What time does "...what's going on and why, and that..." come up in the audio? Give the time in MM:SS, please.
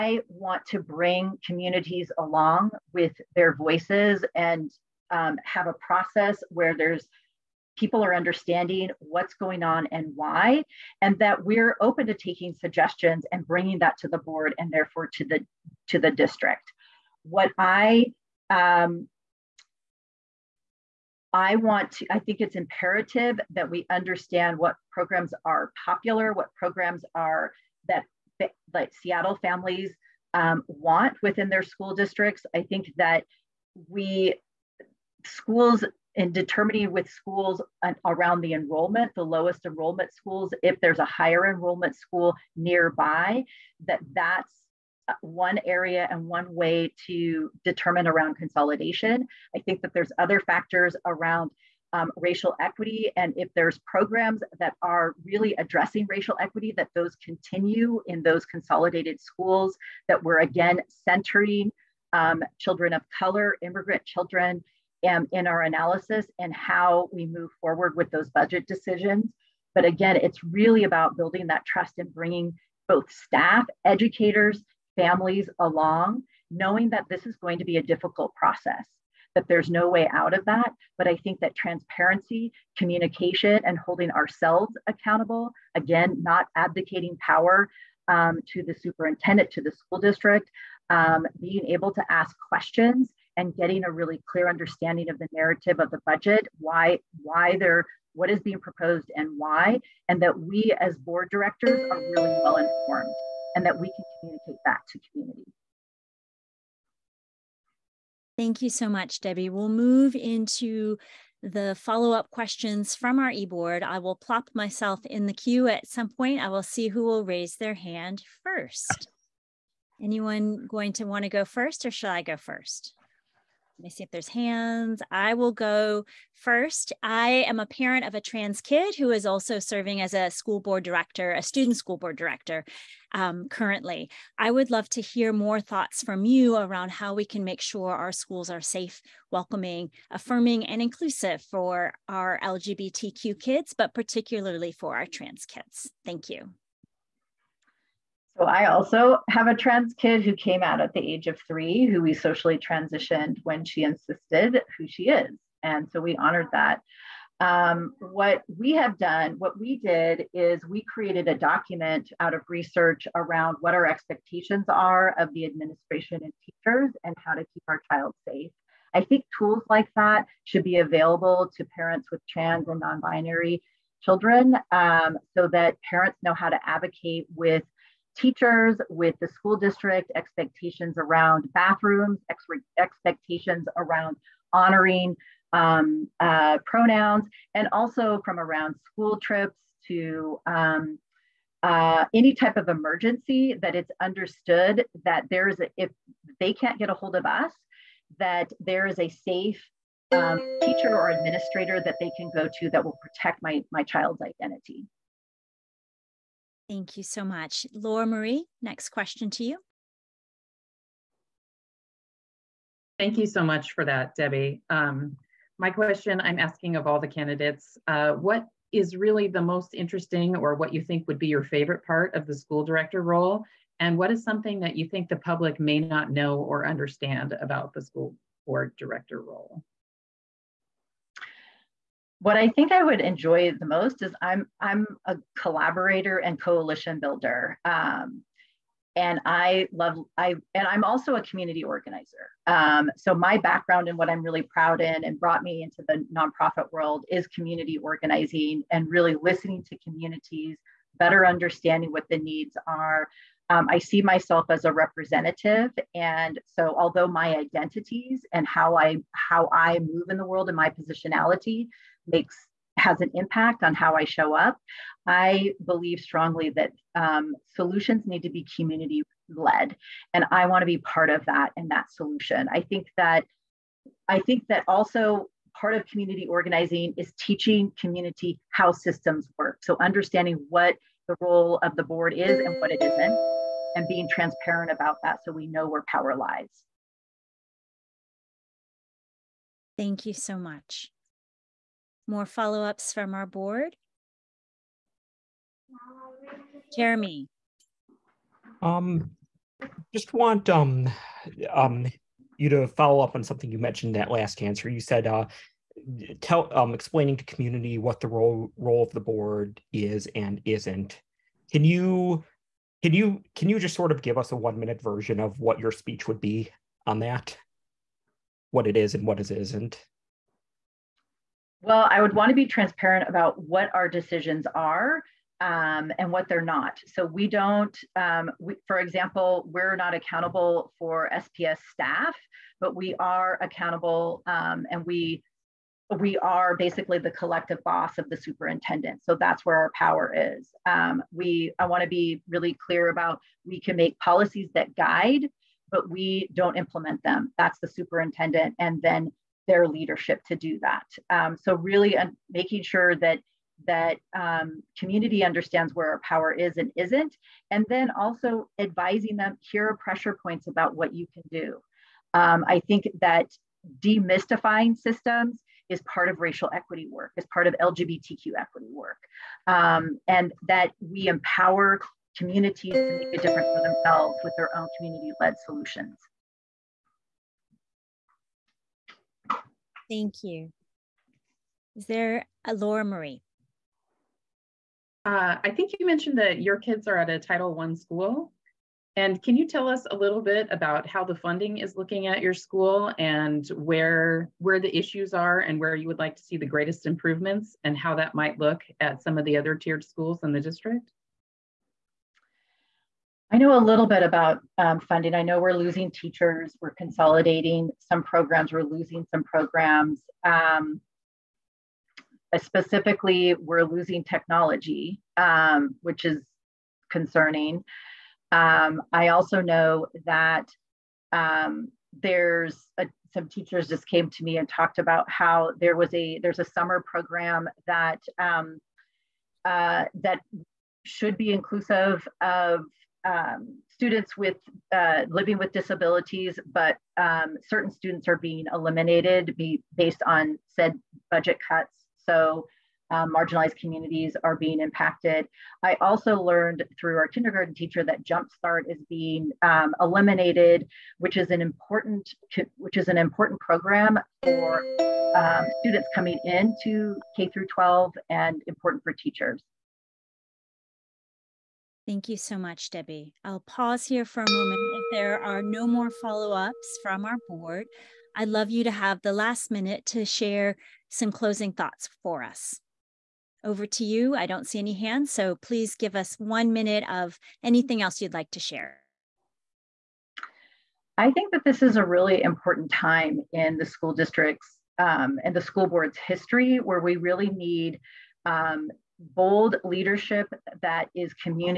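00:08.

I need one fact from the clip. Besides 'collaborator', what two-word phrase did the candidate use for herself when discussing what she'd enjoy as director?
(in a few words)
coalition builder.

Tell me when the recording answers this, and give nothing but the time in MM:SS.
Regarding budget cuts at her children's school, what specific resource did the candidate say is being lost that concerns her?
06:54.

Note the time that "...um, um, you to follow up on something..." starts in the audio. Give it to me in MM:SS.
05:00.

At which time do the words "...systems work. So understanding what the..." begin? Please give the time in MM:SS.
04:38.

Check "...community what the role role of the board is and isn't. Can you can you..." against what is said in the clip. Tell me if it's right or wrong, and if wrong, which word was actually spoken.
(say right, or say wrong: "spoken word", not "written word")
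right.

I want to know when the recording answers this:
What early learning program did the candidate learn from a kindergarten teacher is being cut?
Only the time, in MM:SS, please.
07:28.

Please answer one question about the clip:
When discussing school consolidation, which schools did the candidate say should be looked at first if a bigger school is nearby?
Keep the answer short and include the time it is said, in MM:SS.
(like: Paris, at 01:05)
lowest enrollment schools, at 00:39.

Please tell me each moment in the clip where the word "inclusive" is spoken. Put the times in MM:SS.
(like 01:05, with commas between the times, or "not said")
02:20, 07:11.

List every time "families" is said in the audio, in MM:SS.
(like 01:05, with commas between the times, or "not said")
00:29, 01:14.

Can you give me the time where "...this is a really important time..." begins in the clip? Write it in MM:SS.
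08:01.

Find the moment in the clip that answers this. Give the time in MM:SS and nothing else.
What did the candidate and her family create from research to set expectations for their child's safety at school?
02:41.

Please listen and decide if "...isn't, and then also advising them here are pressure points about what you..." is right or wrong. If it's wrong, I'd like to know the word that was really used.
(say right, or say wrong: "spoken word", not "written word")
right.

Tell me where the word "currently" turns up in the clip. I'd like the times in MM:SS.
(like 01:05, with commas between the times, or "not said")
02:13.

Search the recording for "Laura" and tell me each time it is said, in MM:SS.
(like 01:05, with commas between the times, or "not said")
03:27, 06:22.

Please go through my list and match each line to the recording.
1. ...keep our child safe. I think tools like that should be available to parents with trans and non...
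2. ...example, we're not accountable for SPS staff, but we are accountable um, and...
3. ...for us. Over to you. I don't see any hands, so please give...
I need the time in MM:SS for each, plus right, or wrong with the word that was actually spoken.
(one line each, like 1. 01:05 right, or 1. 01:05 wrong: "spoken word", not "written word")
1. 02:47 right
2. 05:28 right
3. 07:52 right.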